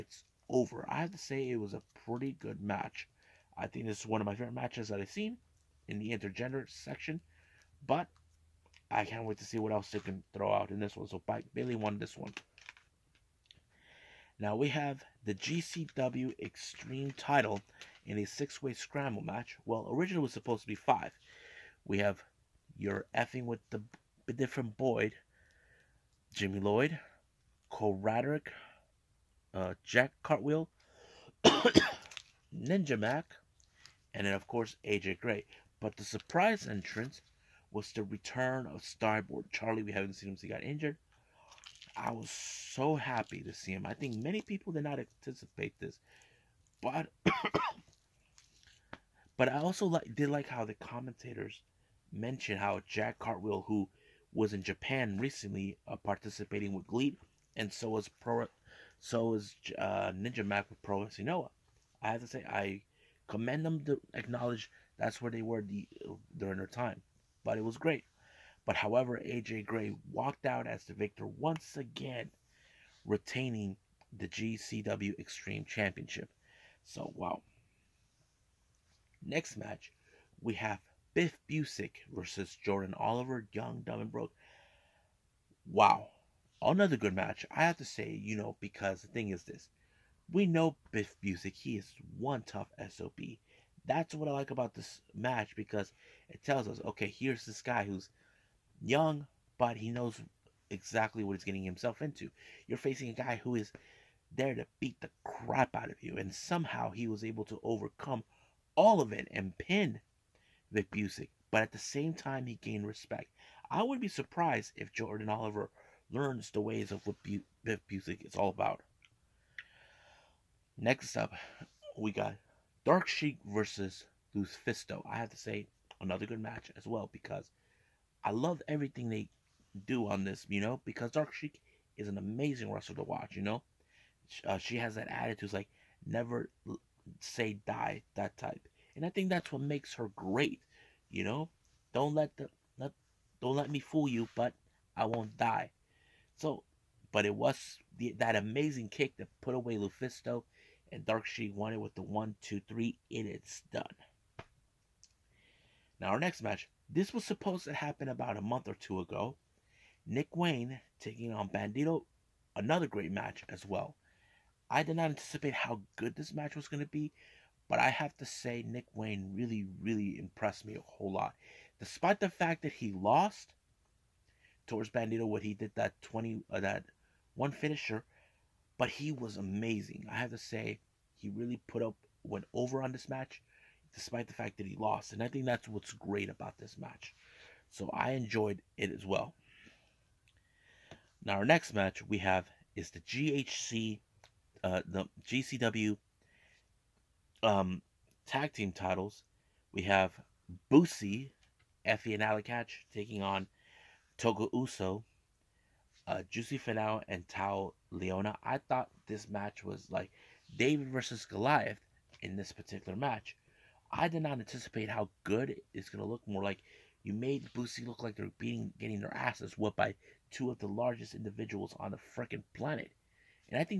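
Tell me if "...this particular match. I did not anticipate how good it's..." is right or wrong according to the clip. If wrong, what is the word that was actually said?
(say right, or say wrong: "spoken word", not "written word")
right.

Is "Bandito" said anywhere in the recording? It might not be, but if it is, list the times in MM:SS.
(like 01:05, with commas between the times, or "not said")
02:41, 02:54.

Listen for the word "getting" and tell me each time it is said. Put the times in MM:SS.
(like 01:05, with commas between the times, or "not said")
01:41, 03:38.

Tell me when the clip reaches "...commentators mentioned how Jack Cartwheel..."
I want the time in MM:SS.
00:50.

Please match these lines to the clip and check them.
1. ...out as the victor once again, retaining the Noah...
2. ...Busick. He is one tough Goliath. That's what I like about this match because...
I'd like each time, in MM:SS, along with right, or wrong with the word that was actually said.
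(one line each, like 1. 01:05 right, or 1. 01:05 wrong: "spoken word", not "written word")
1. 01:10 wrong: "GCW", not "Noah"
2. 01:31 wrong: "SOB", not "Goliath".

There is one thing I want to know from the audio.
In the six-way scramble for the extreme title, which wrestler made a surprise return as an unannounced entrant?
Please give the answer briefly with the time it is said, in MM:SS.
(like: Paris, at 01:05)
Starboy, at 00:38.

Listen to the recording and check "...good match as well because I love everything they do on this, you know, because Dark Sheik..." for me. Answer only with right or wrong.
right.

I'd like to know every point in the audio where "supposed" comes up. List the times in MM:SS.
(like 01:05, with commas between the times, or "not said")
00:20, 02:37.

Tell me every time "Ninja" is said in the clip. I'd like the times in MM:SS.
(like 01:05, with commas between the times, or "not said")
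00:32, 01:00.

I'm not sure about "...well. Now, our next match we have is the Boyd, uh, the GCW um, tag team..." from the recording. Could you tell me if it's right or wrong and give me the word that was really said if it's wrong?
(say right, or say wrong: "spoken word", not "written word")
wrong: "GHC", not "Boyd".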